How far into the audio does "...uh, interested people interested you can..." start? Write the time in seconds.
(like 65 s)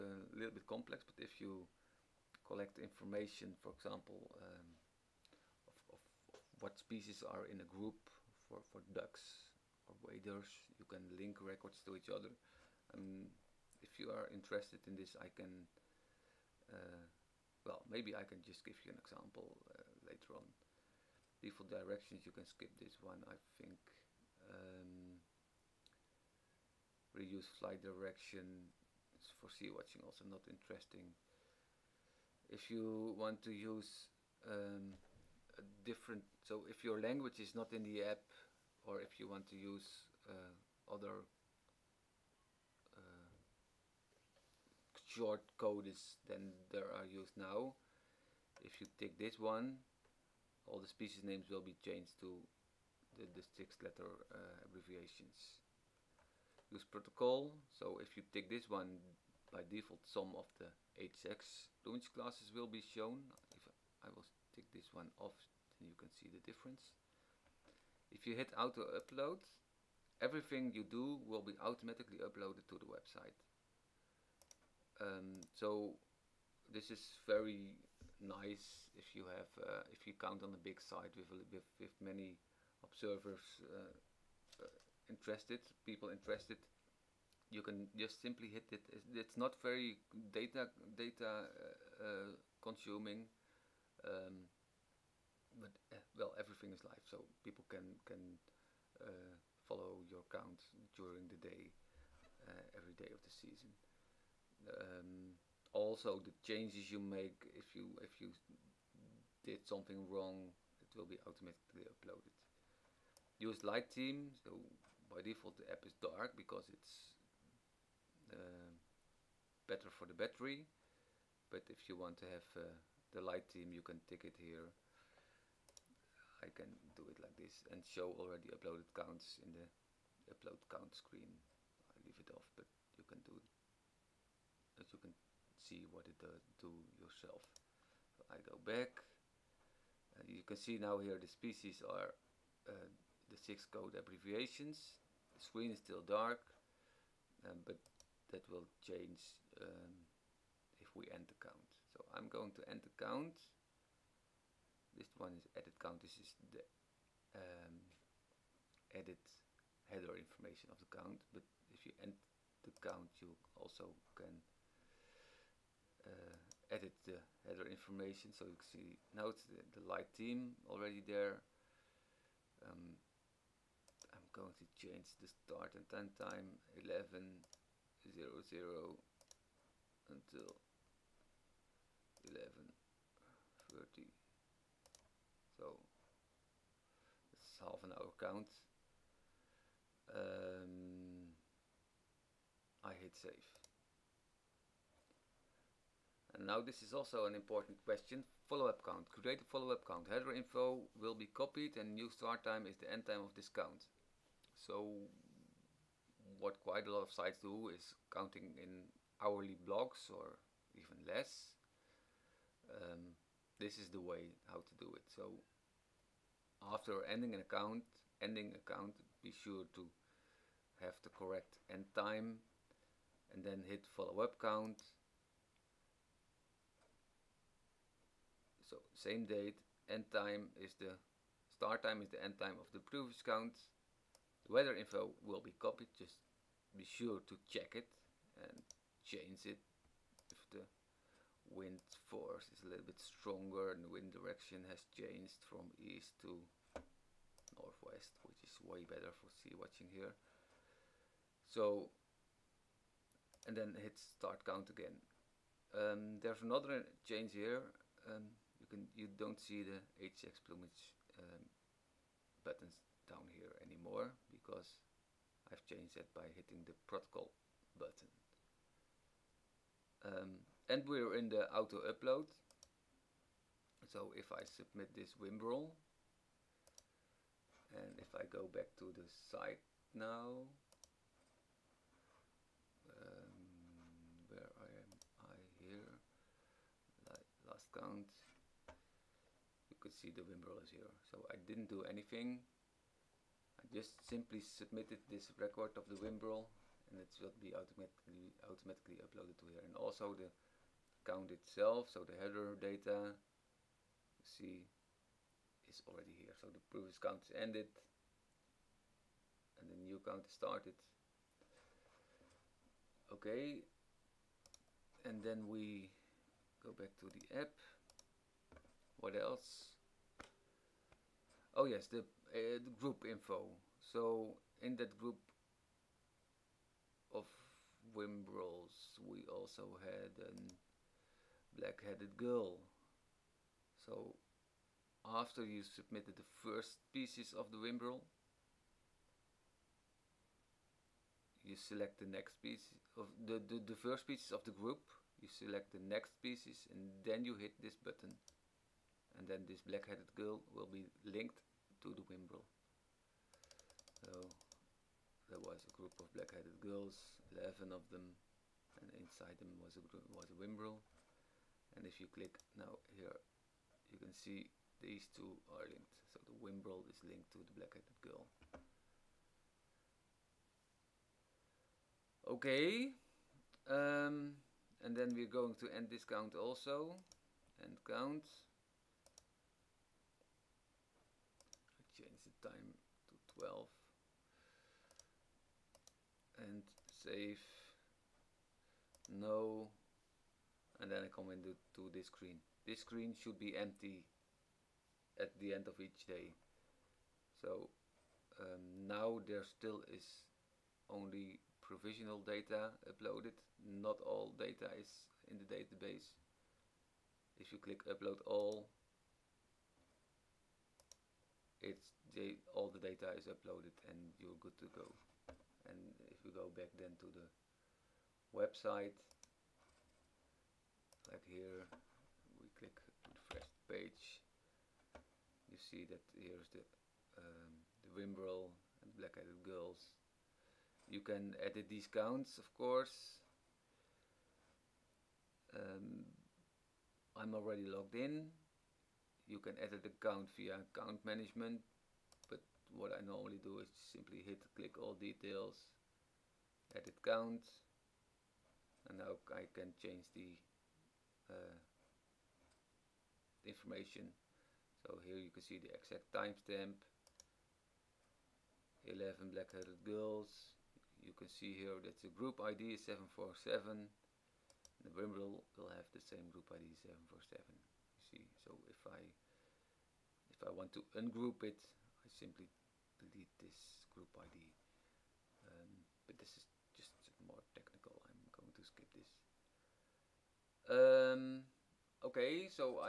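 84 s.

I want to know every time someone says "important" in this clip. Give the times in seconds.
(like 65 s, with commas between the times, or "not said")
197 s.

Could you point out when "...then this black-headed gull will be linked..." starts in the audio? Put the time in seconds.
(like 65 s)
349 s.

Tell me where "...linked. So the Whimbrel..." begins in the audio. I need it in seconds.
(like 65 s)
365 s.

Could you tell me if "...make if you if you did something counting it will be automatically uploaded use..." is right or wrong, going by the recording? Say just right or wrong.
wrong.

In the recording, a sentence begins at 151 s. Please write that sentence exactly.
So I'm going to end the count.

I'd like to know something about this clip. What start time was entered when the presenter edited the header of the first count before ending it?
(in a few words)
11:00.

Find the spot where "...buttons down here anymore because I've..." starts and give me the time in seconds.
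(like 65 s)
262 s.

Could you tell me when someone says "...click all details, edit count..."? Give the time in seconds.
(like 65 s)
444 s.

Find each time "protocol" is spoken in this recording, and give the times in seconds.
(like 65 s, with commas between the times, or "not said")
56 s, 266 s.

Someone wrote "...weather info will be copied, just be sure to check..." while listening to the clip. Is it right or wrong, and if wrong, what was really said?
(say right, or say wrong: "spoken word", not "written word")
right.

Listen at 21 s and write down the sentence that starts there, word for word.
Default directions, you can skip this one, I think.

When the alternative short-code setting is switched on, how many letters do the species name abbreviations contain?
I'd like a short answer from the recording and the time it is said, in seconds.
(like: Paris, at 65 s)
6, at 53 s.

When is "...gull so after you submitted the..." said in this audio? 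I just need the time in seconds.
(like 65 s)
332 s.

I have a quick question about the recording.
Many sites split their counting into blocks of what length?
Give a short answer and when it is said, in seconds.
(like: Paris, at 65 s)
Hourly, at 209 s.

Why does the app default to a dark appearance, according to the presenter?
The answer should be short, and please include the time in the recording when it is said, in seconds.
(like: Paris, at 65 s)
Better for the battery, at 119 s.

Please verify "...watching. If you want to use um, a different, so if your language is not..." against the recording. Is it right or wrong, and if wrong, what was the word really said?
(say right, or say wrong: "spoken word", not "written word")
wrong: "interesting", not "watching".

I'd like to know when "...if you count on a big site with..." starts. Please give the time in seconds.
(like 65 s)
79 s.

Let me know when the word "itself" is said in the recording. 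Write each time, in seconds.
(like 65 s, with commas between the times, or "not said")
301 s.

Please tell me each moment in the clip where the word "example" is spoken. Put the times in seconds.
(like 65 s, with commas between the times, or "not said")
3 s, 19 s.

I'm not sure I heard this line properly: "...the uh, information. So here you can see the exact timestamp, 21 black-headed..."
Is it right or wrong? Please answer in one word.
wrong.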